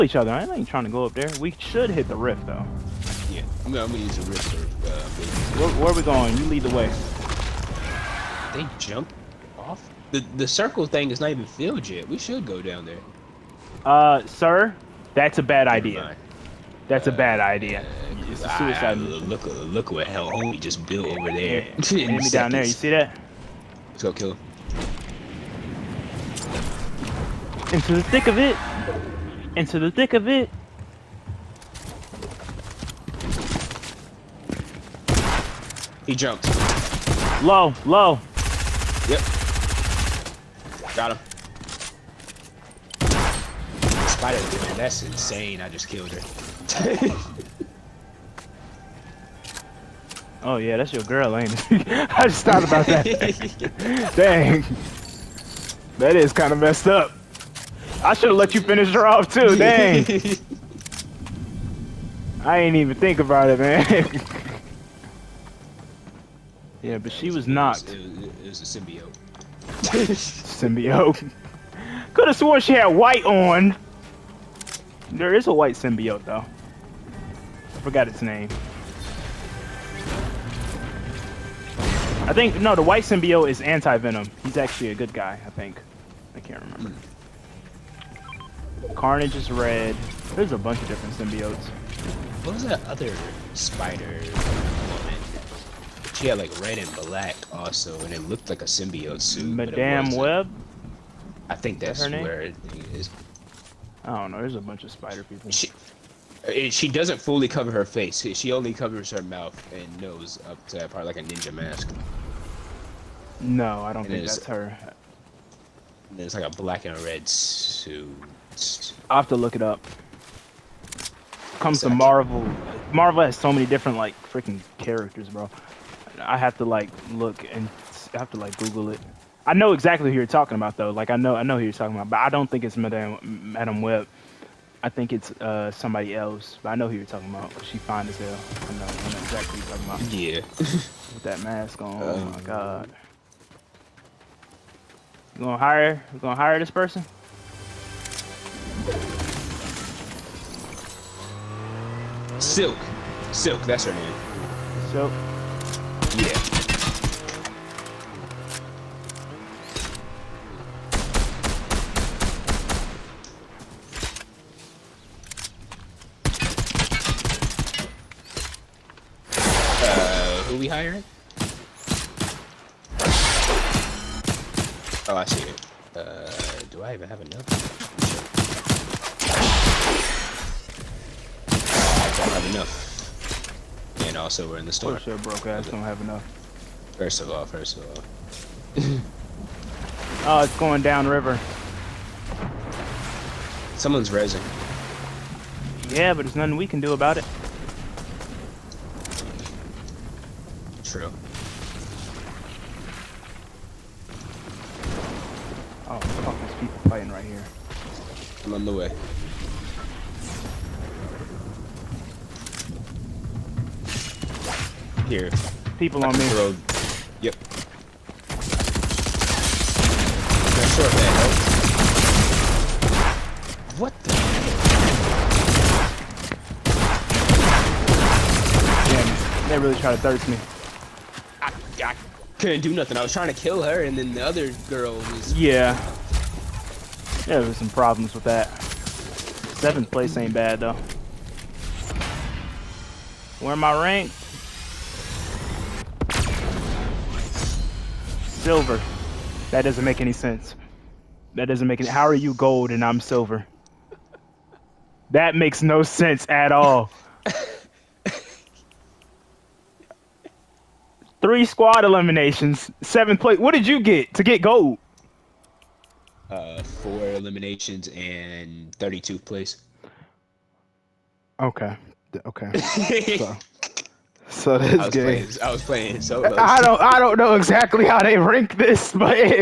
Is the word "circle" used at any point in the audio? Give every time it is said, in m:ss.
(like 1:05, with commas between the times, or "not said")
0:10.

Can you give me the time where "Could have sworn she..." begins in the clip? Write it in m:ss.
1:12.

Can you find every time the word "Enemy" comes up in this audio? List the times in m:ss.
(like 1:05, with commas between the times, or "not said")
0:22.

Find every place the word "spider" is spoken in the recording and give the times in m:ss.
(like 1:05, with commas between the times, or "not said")
1:33, 1:44.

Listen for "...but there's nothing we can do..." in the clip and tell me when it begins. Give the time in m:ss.
3:16.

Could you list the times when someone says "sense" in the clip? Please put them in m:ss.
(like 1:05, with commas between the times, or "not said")
4:10, 4:15.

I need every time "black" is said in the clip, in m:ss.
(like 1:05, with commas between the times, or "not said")
1:36, 1:56.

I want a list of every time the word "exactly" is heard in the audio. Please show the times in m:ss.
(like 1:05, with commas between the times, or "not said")
2:01, 2:09, 2:19, 4:37.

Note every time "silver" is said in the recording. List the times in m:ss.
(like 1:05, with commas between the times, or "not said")
4:08, 4:12.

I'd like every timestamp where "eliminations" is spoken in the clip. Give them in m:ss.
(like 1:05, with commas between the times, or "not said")
4:21, 4:27.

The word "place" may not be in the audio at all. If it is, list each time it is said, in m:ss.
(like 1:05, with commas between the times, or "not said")
3:59, 4:23, 4:29.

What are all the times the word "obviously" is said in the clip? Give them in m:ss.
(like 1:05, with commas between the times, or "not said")
not said.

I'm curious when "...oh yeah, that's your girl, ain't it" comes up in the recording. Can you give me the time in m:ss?
0:50.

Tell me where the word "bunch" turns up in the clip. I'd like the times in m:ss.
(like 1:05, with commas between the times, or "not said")
1:30, 1:44.